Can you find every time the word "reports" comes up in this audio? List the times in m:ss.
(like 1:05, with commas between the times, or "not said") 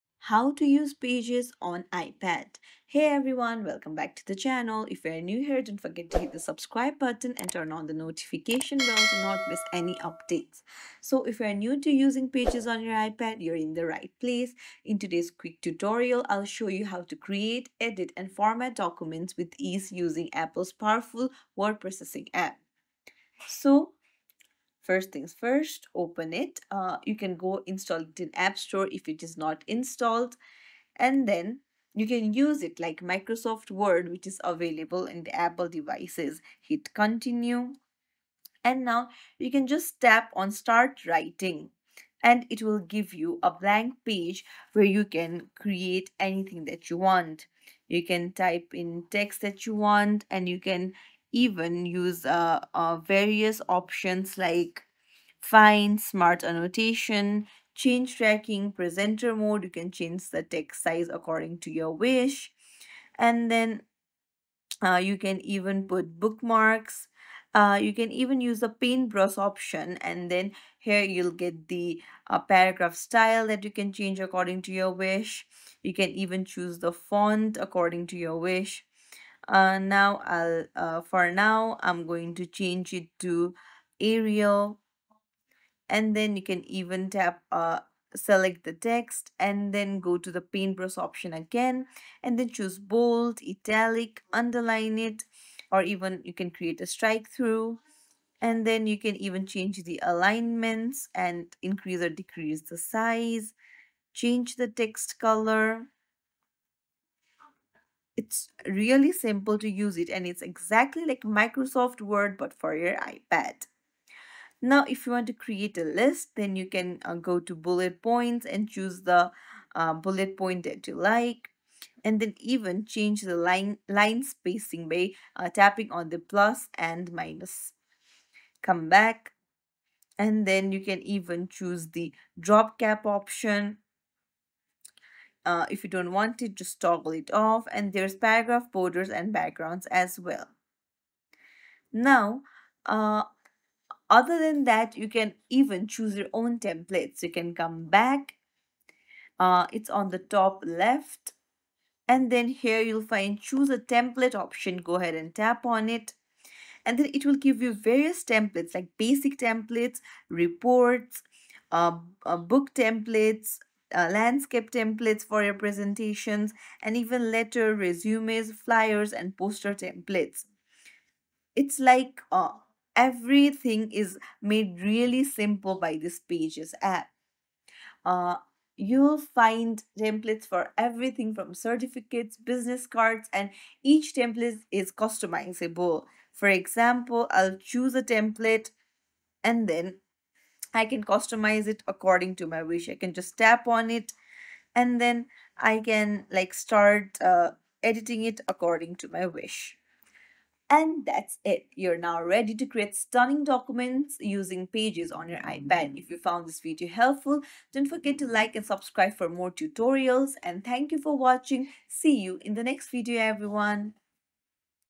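2:40.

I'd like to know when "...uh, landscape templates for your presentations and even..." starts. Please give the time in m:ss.
2:43.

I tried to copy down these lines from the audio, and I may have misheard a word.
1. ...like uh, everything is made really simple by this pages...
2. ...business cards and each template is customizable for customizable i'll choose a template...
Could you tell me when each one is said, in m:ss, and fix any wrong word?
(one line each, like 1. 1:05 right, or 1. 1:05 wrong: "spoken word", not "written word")
1. 2:51 right
2. 3:02 wrong: "example", not "customizable".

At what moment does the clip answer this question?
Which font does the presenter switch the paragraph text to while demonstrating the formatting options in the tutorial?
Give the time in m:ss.
1:23.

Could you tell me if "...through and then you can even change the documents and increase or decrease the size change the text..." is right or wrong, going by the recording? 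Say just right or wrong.
wrong.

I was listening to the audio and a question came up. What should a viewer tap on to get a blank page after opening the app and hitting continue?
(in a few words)
Start writing.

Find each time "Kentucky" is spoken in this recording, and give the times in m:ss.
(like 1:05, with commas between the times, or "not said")
not said.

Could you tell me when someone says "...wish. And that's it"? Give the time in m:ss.
3:19.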